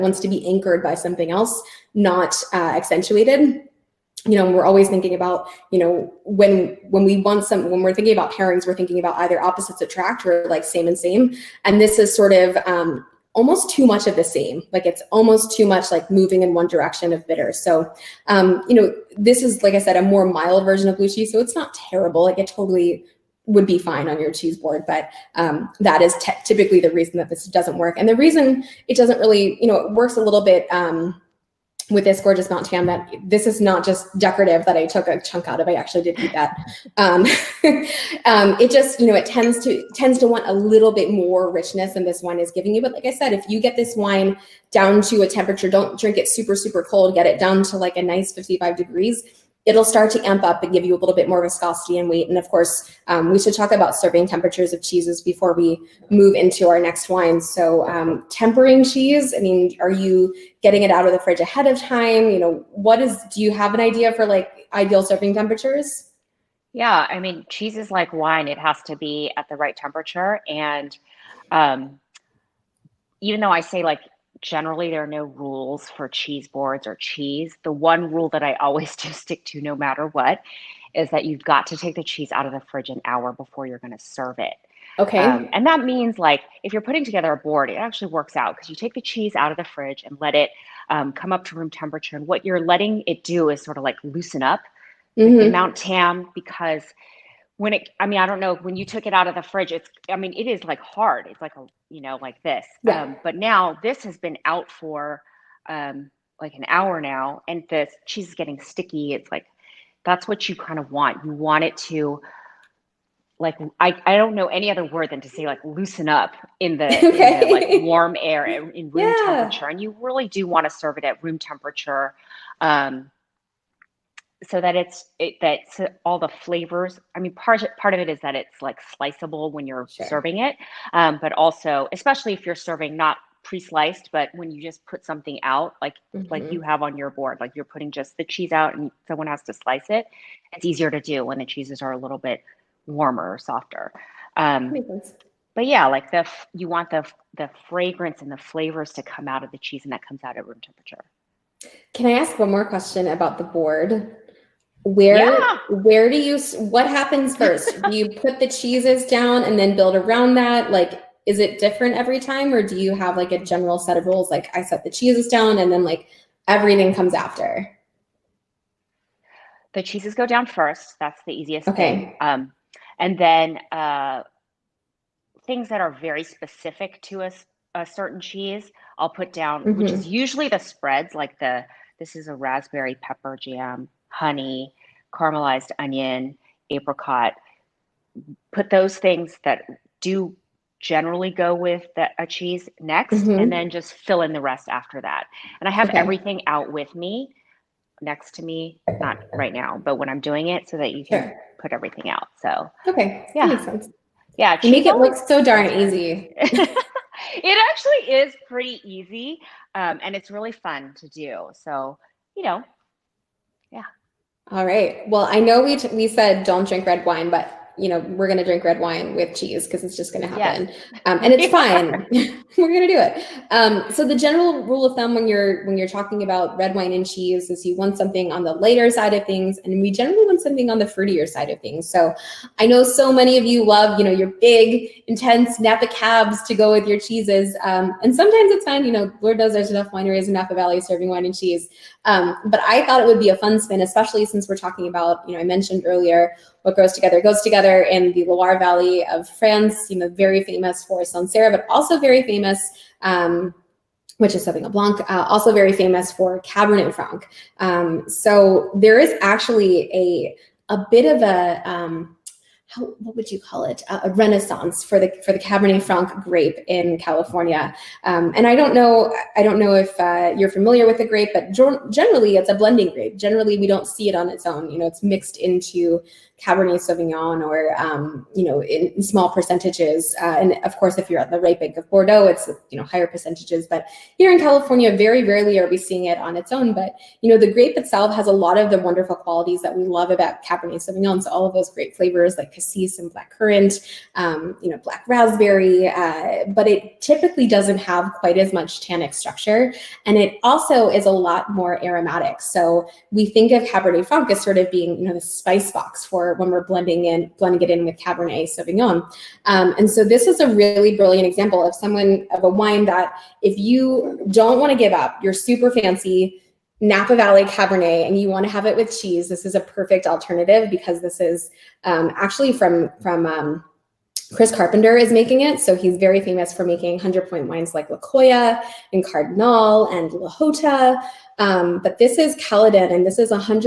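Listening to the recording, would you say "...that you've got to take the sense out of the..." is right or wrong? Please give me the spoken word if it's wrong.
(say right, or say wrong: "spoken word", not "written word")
wrong: "cheese", not "sense".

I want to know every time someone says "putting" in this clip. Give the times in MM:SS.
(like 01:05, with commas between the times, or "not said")
01:26, 02:17.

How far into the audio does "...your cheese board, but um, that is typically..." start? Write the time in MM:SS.
00:24.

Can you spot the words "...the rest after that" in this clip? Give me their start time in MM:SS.
03:14.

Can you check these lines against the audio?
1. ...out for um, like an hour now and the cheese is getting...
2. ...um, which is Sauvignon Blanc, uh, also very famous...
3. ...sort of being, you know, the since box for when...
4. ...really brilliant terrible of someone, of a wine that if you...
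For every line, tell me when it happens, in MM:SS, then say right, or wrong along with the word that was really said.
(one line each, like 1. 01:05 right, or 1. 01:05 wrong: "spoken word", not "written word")
1. 01:44 right
2. 04:13 right
3. 05:04 wrong: "spice", not "since"
4. 05:10 wrong: "example", not "terrible".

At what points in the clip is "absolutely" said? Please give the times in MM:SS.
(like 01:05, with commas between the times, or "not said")
not said.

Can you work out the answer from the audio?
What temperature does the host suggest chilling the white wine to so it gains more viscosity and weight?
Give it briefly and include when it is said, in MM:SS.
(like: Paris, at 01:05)
55 degrees, at 00:48.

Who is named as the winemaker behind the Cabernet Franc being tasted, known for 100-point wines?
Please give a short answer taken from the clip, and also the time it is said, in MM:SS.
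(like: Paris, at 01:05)
Chris Carpenter, at 05:24.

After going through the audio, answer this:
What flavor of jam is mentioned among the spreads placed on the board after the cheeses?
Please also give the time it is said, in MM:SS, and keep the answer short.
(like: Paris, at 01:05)
raspberry pepper, at 03:02.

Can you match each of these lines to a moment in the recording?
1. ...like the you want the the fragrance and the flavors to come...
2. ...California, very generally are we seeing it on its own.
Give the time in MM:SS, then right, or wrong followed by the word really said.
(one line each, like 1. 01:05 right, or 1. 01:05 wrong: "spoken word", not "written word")
1. 02:25 right
2. 04:44 wrong: "rarely", not "generally".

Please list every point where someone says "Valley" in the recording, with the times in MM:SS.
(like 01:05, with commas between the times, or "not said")
04:00, 04:08, 05:17.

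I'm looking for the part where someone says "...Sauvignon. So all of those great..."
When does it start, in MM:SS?
04:50.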